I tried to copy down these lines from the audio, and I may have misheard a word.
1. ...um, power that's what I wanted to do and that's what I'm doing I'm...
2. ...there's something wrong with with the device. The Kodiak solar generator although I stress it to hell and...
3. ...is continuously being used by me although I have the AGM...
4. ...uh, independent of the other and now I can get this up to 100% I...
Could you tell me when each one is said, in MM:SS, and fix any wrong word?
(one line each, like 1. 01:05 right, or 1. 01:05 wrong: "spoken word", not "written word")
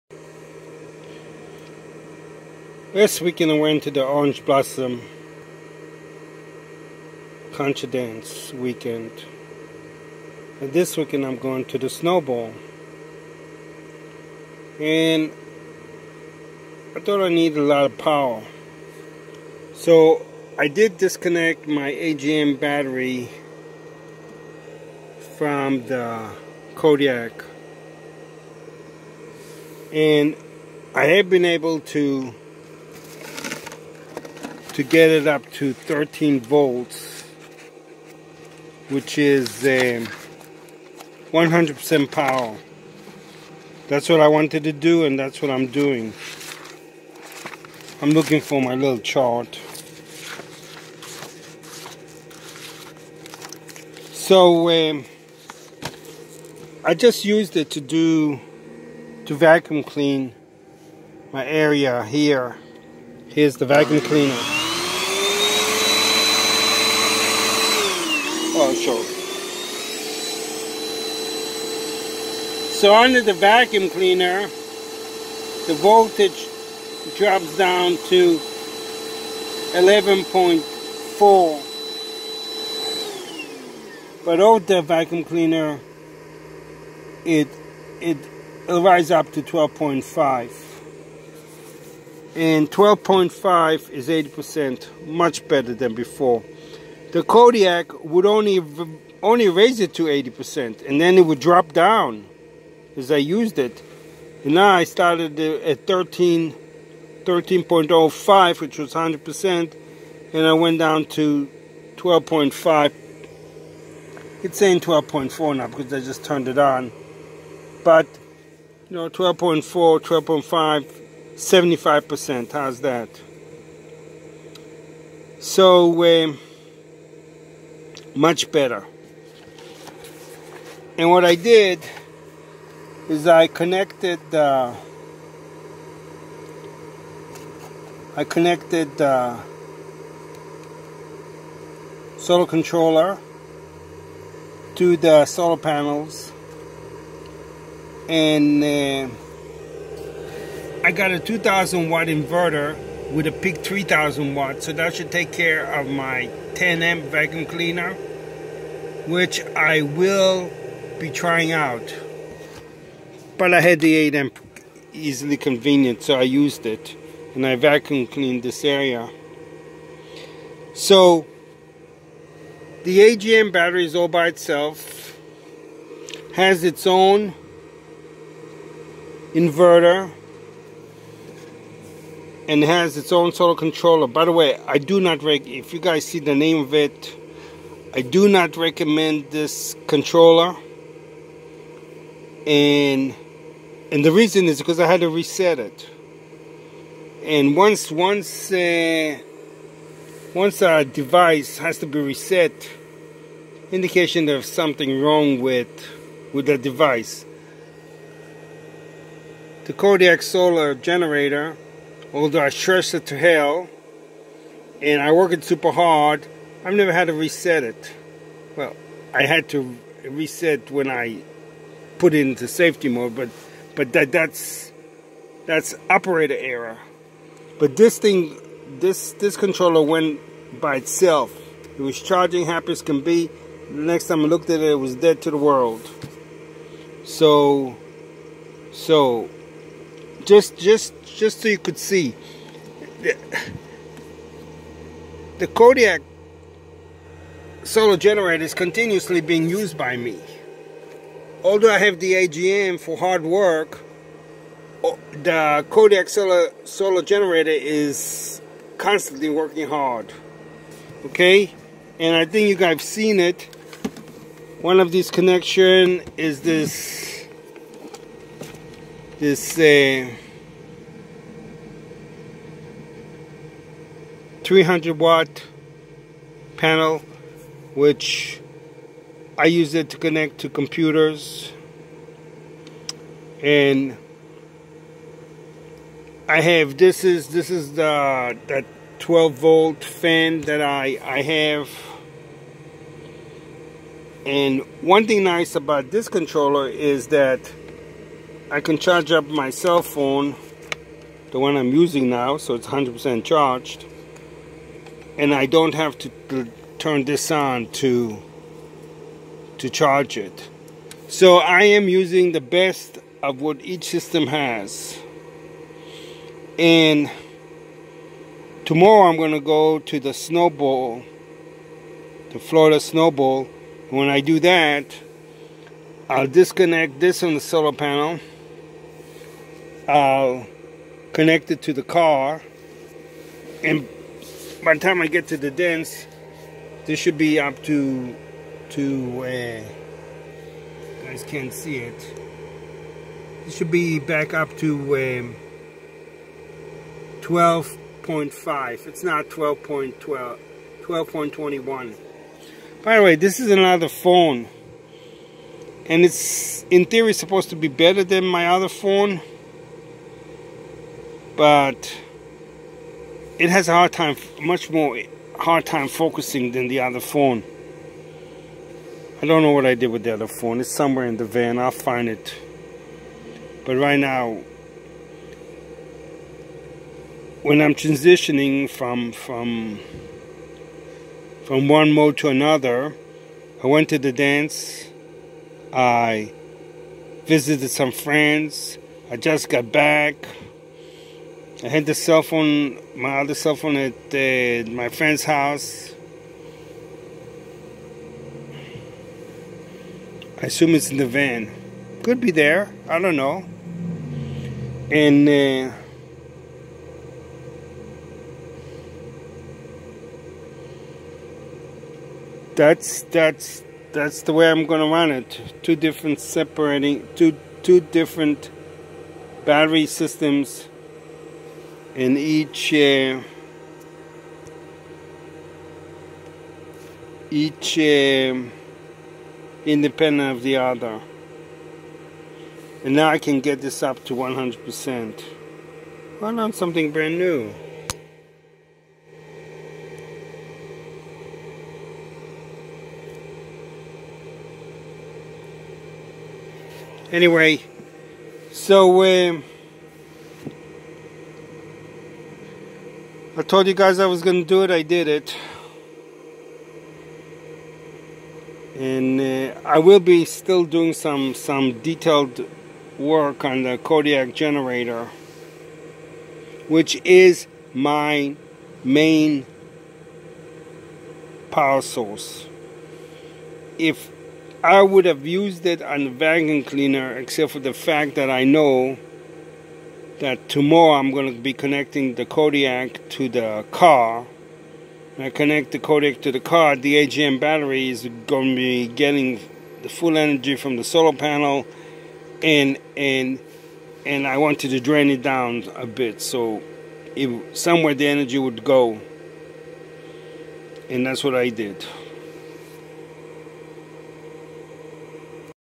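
1. 00:41 right
2. 03:24 right
3. 04:08 right
4. 07:07 right.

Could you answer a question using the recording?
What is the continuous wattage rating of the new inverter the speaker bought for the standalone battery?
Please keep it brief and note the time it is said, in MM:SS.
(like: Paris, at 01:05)
2000 watts, at 02:31.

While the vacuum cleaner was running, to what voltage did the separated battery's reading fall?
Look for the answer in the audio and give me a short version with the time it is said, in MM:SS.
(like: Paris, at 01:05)
11.4, at 01:19.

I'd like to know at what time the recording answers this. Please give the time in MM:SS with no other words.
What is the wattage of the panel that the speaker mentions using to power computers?
04:34.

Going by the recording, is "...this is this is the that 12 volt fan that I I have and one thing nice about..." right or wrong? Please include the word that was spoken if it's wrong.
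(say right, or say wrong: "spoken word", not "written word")
right.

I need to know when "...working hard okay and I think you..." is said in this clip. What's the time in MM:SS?
04:19.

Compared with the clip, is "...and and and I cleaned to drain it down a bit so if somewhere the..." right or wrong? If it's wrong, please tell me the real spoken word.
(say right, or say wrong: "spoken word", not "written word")
wrong: "wanted", not "cleaned".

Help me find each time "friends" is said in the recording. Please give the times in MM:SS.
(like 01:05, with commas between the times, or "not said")
06:27, 06:34.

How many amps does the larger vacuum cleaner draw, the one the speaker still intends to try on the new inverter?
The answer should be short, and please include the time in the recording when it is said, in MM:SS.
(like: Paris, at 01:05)
10 amps, at 02:36.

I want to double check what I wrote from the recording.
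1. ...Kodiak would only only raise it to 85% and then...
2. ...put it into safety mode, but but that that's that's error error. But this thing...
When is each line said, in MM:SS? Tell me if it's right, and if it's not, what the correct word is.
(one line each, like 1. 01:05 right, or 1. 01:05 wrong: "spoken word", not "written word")
1. 01:37 wrong: "80", not "85"
2. 03:41 wrong: "operator", not "error".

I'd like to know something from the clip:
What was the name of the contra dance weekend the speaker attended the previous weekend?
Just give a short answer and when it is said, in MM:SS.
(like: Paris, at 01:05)
Orange Blossom, at 00:04.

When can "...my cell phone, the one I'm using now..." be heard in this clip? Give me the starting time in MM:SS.
04:59.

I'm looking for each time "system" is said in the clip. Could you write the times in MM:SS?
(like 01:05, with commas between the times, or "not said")
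05:13, 06:59.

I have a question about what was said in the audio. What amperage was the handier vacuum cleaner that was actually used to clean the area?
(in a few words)
8 amps.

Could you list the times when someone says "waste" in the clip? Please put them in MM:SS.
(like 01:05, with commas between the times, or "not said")
not said.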